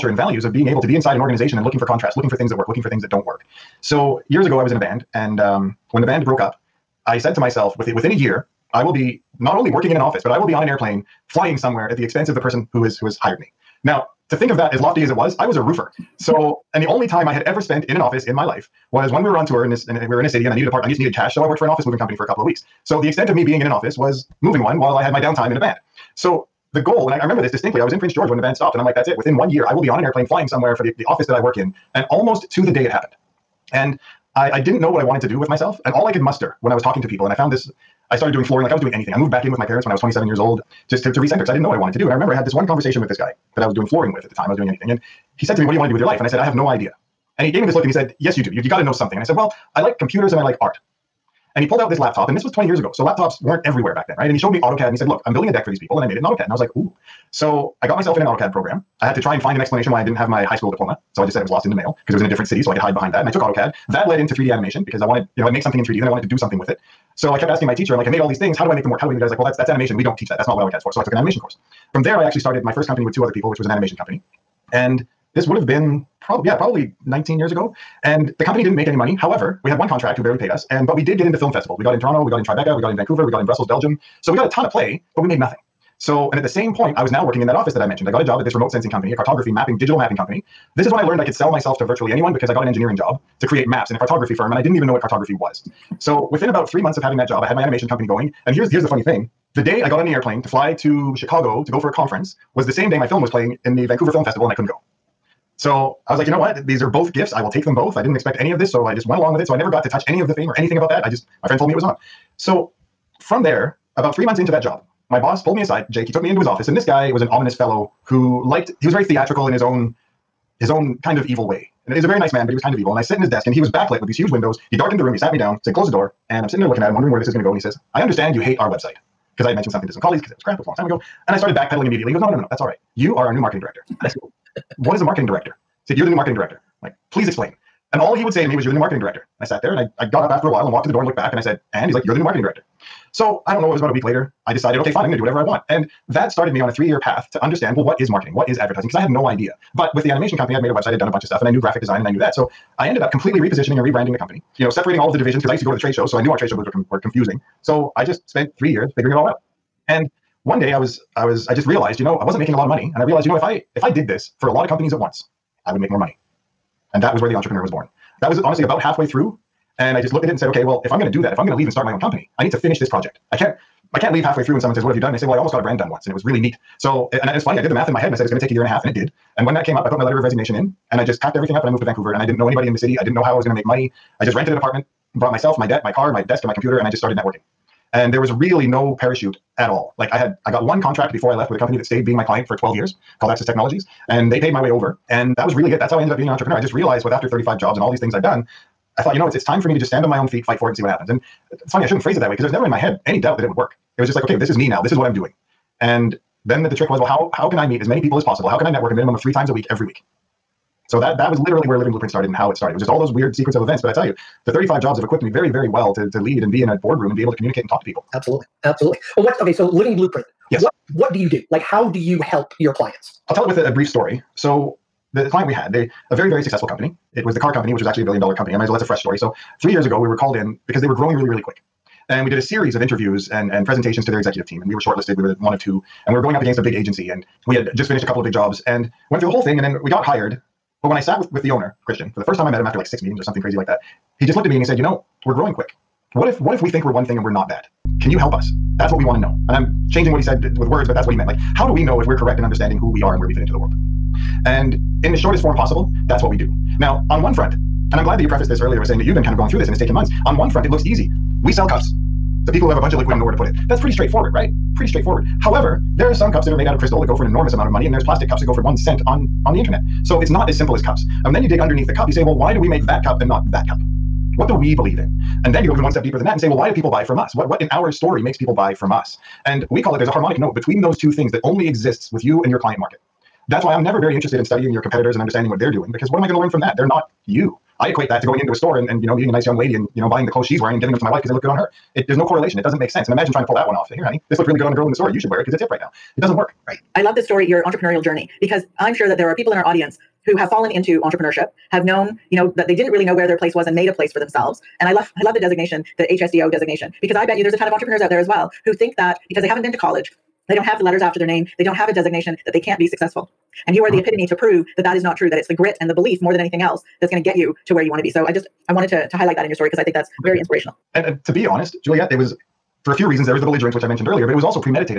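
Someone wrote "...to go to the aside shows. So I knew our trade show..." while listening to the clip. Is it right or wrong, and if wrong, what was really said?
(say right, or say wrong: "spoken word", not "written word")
wrong: "trade", not "aside".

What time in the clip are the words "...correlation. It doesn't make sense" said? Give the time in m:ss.
4:52.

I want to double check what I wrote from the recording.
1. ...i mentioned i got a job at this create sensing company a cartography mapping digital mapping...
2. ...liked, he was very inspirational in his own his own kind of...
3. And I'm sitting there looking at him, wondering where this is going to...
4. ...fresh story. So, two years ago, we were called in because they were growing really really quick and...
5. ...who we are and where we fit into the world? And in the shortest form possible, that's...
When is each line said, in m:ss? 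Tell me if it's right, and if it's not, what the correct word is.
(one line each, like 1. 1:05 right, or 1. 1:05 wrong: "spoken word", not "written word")
1. 1:27 wrong: "remote", not "create"
2. 1:58 wrong: "theatrical", not "inspirational"
3. 2:06 right
4. 3:48 wrong: "three", not "two"
5. 4:12 right.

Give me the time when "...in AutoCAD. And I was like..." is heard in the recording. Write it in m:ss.
0:56.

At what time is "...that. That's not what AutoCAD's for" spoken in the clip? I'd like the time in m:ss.
1:10.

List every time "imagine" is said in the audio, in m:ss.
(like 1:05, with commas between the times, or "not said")
4:53.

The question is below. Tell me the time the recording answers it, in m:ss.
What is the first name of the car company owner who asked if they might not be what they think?
4:01.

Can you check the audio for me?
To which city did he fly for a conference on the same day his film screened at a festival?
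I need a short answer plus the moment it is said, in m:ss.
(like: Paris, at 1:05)
Chicago, at 1:41.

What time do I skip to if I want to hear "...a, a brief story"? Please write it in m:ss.
3:43.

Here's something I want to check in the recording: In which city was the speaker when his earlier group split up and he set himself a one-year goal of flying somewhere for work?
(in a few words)
Prince George.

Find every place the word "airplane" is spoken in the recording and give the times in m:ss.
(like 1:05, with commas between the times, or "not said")
0:10, 0:30, 1:40.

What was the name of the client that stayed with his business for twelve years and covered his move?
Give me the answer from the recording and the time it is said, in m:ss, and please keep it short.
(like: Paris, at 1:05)
Access Technologies, at 3:13.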